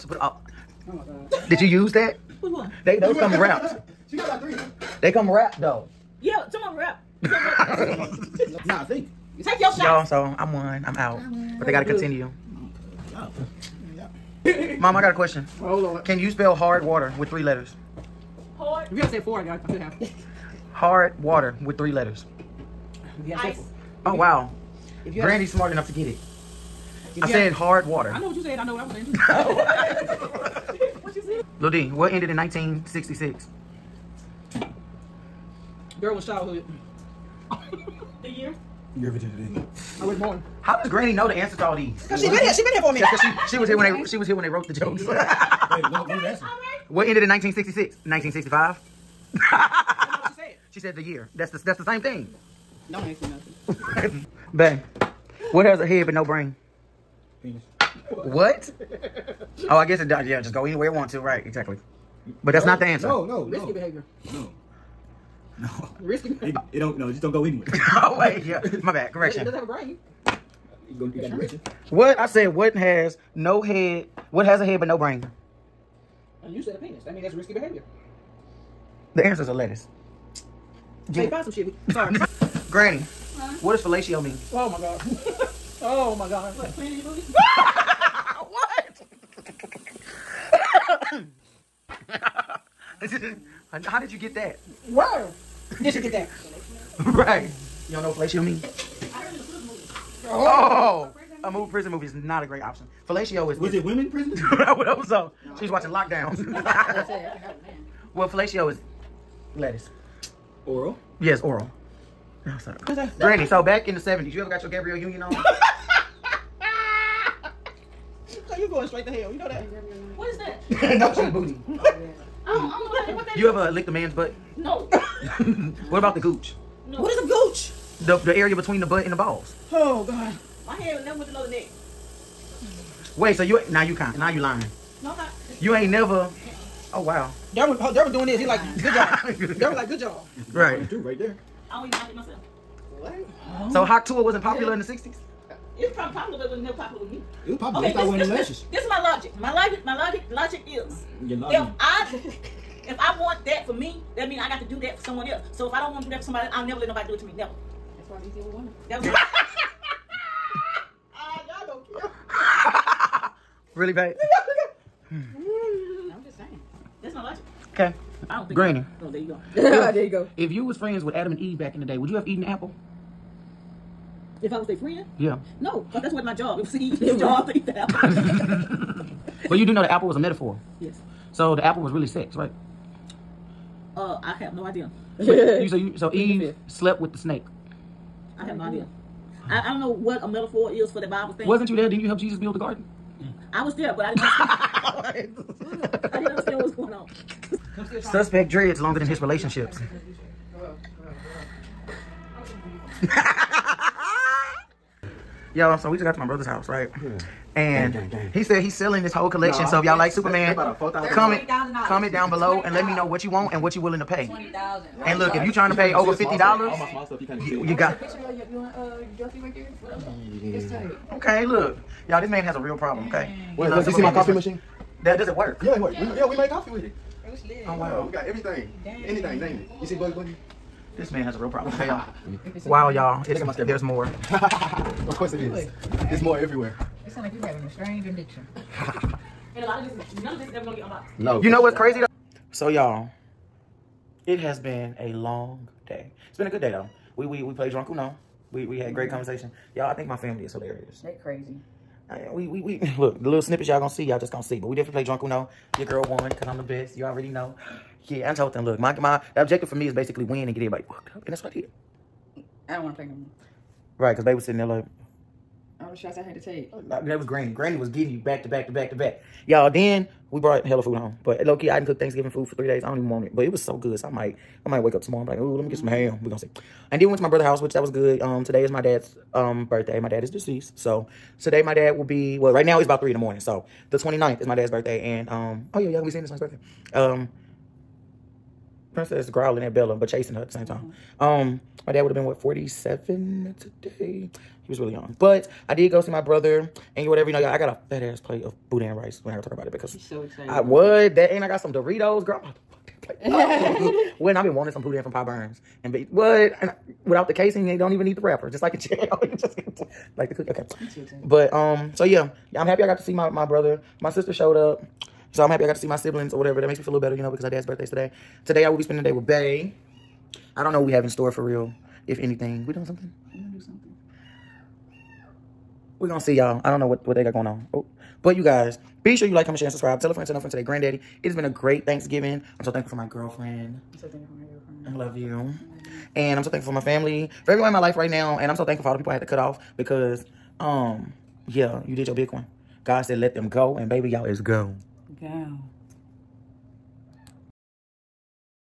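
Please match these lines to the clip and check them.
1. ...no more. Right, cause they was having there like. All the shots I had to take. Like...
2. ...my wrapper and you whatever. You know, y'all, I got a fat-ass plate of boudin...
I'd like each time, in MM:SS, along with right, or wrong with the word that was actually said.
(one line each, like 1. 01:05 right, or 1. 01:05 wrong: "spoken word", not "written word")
1. 04:23 wrong: "sitting", not "having"
2. 04:56 wrong: "brother", not "wrapper".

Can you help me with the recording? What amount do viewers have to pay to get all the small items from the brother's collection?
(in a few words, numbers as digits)
$50.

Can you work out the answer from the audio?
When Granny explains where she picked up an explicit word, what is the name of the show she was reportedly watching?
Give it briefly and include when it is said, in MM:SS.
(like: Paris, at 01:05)
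Lockdown, at 01:45.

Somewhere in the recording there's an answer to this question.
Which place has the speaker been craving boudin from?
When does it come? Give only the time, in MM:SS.
05:05.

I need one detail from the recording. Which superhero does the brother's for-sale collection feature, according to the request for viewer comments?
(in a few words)
Superman.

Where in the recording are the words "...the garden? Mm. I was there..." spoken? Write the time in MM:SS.
03:12.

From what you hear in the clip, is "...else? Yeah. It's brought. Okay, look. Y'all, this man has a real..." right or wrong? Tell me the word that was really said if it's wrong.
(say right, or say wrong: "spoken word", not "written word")
wrong: "tight", not "brought".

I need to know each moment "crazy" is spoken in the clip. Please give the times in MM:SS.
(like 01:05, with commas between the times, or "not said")
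04:01, 04:11.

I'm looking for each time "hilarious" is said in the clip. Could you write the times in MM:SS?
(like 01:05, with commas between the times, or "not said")
04:10.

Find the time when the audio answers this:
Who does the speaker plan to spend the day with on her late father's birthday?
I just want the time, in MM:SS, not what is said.
05:19.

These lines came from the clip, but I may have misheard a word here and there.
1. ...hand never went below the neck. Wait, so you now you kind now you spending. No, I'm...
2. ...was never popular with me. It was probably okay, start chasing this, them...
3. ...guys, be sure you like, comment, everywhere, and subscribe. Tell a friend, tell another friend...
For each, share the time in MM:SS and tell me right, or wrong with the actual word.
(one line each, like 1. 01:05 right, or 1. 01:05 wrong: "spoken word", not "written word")
1. 02:10 wrong: "lying", not "spending"
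2. 02:26 wrong: "wearing", not "chasing"
3. 05:28 wrong: "share", not "everywhere".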